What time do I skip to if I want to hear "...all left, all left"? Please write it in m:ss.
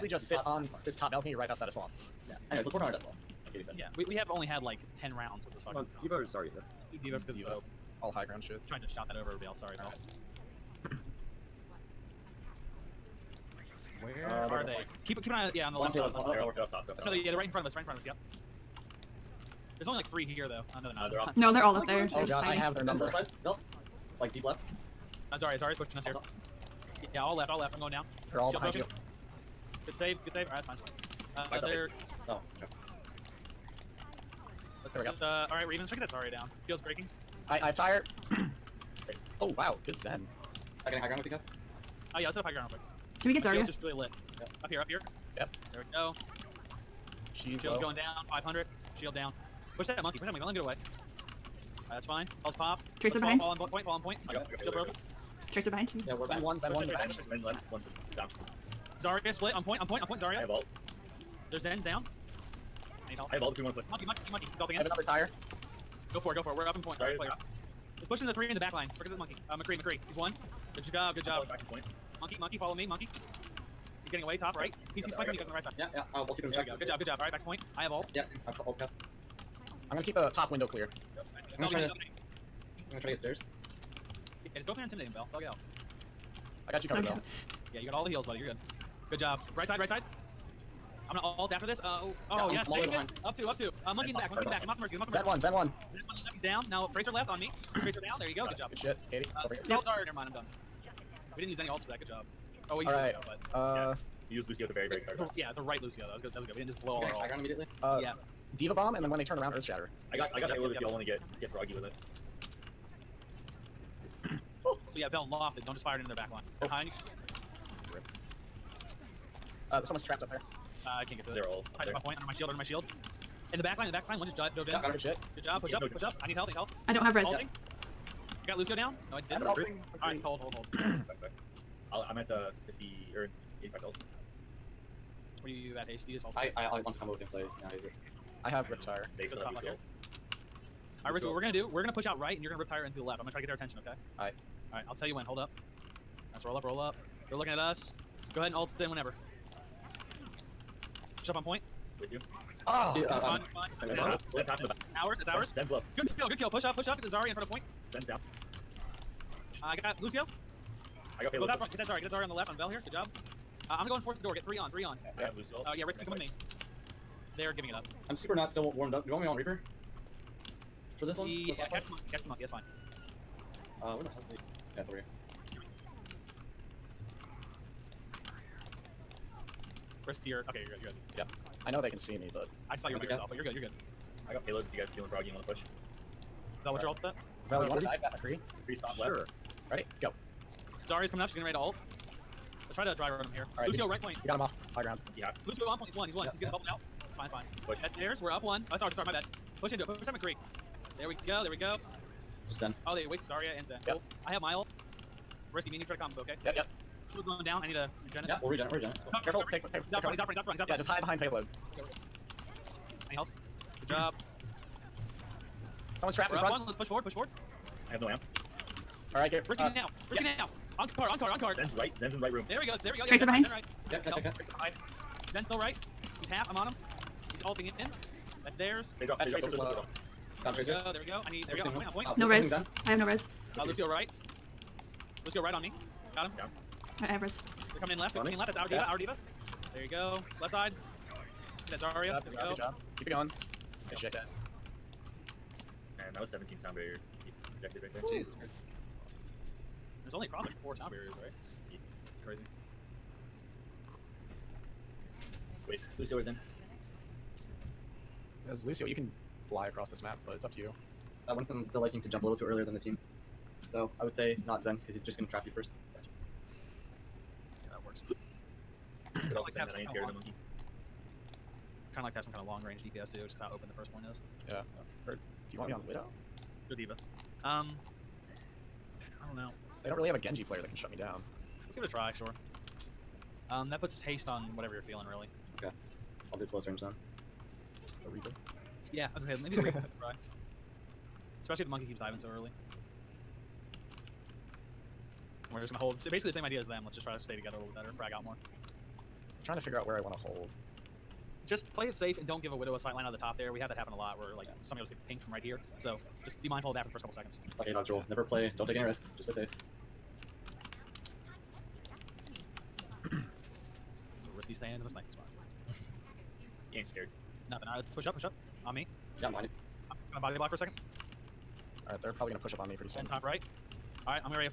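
0:27.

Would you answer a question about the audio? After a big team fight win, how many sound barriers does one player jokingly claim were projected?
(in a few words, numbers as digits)
17.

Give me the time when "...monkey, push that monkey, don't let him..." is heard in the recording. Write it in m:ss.
0:50.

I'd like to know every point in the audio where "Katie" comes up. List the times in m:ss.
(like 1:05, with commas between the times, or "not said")
0:03, 1:39.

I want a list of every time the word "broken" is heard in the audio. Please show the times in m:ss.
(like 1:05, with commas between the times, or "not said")
0:28, 0:54.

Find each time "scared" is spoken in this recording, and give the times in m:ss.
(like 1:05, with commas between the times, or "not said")
4:29, 5:16.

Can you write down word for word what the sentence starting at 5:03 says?
We have that happen a lot where like yeah.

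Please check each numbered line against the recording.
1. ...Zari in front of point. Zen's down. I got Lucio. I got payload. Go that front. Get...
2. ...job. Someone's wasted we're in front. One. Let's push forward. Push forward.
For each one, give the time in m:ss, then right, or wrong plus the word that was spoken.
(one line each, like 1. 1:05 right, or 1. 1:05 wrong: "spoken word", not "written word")
1. 2:37 right
2. 3:33 wrong: "trapped", not "wasted".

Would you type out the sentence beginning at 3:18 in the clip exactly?
Oh, that's ours, that's ours, my bad.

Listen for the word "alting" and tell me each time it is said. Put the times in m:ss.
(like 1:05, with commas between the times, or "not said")
3:47.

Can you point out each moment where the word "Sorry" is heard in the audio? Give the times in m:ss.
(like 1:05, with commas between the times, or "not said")
0:09, 1:06.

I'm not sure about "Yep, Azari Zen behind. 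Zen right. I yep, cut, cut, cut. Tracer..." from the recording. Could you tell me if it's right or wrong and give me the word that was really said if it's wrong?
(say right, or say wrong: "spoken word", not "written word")
wrong: "Tracer", not "Azari".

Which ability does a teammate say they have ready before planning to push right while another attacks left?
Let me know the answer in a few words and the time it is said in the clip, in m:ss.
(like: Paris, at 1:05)
Riptire, at 2:18.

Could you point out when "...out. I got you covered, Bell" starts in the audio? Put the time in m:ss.
1:25.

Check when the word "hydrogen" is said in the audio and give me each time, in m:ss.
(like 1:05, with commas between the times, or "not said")
not said.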